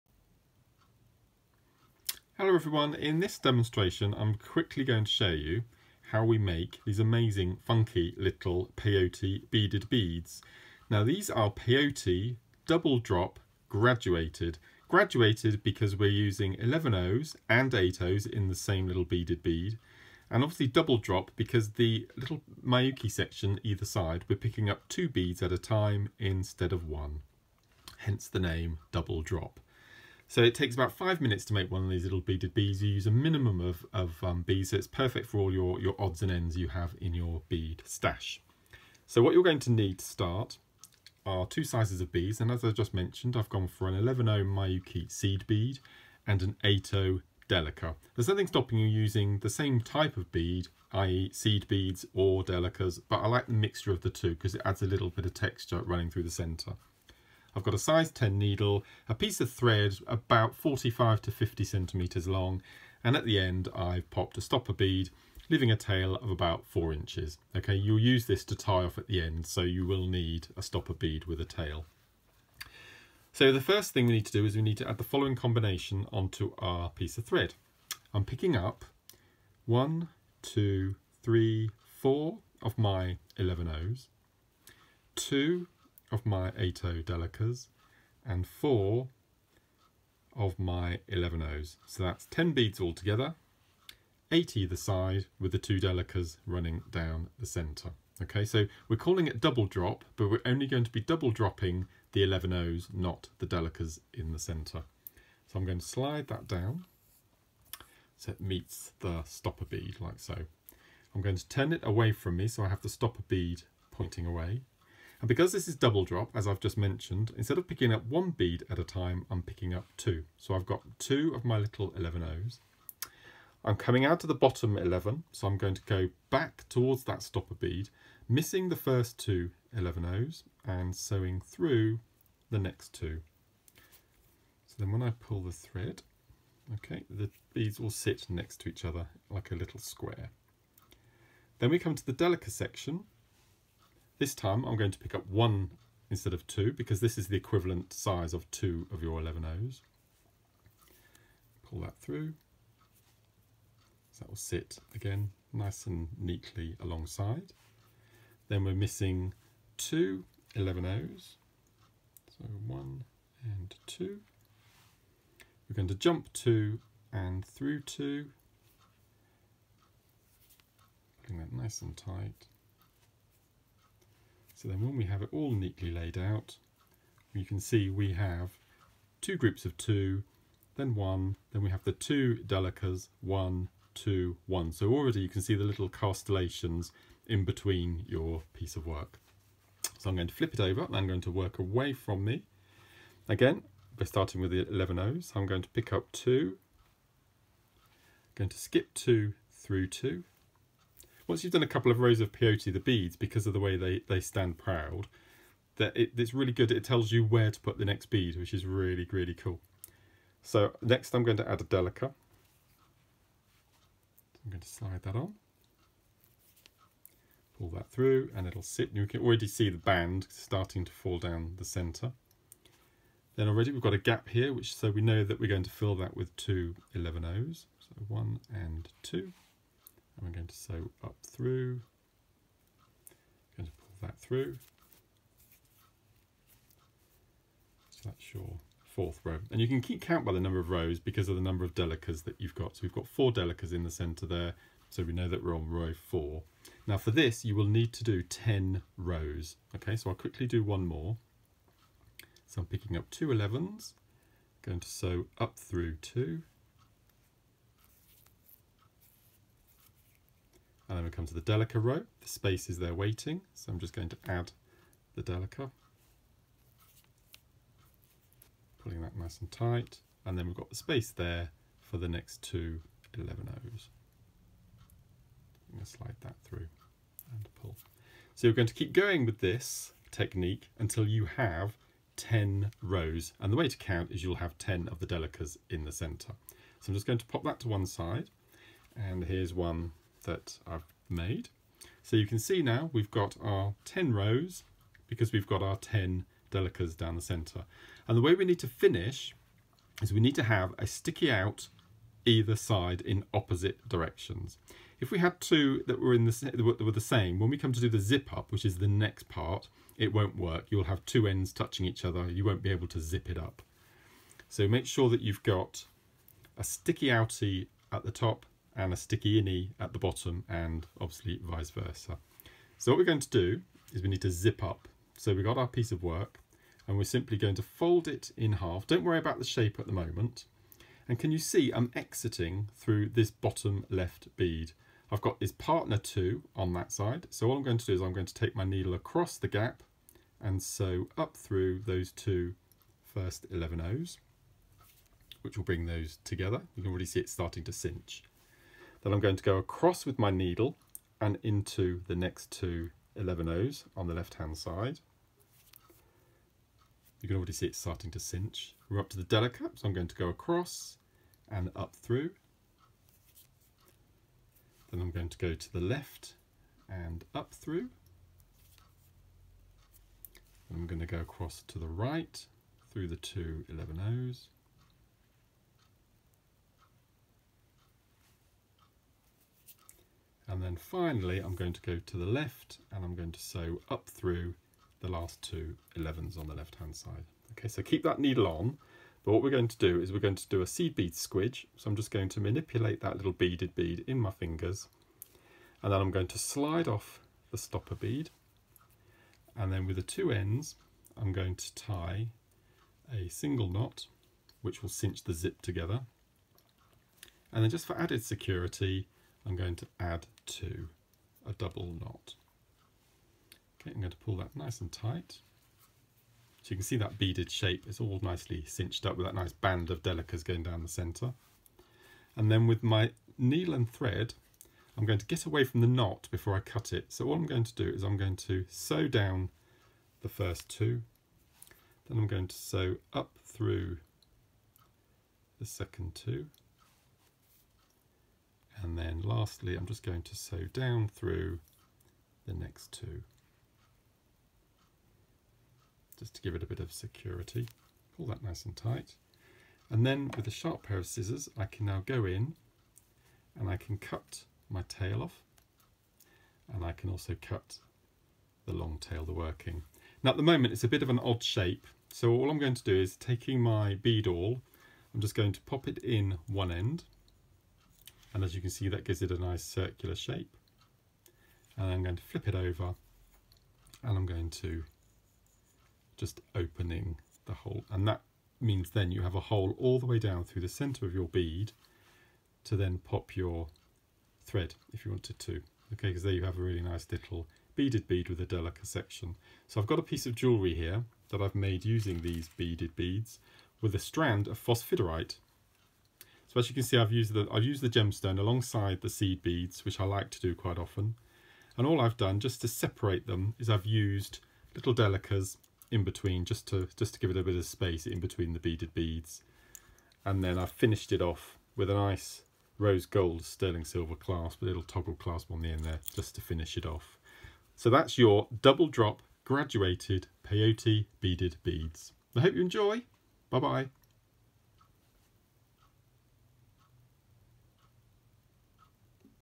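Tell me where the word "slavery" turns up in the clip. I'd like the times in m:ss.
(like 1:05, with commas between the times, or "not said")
not said.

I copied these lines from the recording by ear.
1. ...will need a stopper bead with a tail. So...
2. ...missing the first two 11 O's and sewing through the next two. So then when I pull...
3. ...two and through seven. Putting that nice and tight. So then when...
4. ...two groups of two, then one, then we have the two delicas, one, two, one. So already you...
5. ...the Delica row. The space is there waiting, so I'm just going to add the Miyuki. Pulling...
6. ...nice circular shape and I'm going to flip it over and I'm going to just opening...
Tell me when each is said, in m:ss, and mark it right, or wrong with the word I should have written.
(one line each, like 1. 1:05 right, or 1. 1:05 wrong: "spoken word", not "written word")
1. 1:09 right
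2. 2:08 right
3. 2:46 wrong: "two", not "seven"
4. 2:59 right
5. 4:21 wrong: "Delica", not "Miyuki"
6. 7:49 right.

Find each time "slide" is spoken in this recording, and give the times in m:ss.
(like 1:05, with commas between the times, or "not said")
1:45, 3:34, 4:35, 6:36.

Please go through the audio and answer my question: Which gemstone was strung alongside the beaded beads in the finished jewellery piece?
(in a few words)
phosphosiderite.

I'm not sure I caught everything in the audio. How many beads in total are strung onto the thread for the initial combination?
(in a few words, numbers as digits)
10.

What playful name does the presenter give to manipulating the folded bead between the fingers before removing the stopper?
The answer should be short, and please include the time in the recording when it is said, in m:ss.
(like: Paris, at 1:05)
seed bead squidge, at 6:30.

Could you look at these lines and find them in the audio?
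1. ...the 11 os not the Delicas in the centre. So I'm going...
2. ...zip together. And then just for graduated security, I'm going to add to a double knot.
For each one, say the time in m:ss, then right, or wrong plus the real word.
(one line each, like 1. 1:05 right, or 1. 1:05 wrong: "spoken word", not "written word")
1. 1:42 right
2. 6:45 wrong: "added", not "graduated".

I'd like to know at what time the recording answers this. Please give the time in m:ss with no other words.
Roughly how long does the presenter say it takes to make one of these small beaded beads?
0:30.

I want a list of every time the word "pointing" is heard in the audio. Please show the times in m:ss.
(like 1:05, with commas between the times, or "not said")
1:53.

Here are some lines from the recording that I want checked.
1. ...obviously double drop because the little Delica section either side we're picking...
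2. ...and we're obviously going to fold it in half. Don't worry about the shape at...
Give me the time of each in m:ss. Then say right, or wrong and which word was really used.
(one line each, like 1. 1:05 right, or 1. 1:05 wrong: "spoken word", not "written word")
1. 0:20 wrong: "Miyuki", not "Delica"
2. 5:26 wrong: "simply", not "obviously".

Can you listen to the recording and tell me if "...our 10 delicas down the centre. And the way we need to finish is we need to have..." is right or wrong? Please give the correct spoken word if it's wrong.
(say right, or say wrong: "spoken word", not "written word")
right.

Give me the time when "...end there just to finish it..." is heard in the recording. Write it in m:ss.
8:35.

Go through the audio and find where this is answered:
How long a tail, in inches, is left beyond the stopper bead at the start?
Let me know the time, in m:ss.
1:06.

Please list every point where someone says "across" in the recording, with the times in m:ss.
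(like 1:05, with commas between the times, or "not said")
5:38, 5:49, 6:00, 6:11.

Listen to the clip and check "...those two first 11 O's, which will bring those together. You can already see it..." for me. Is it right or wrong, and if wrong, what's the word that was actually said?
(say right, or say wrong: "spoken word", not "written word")
right.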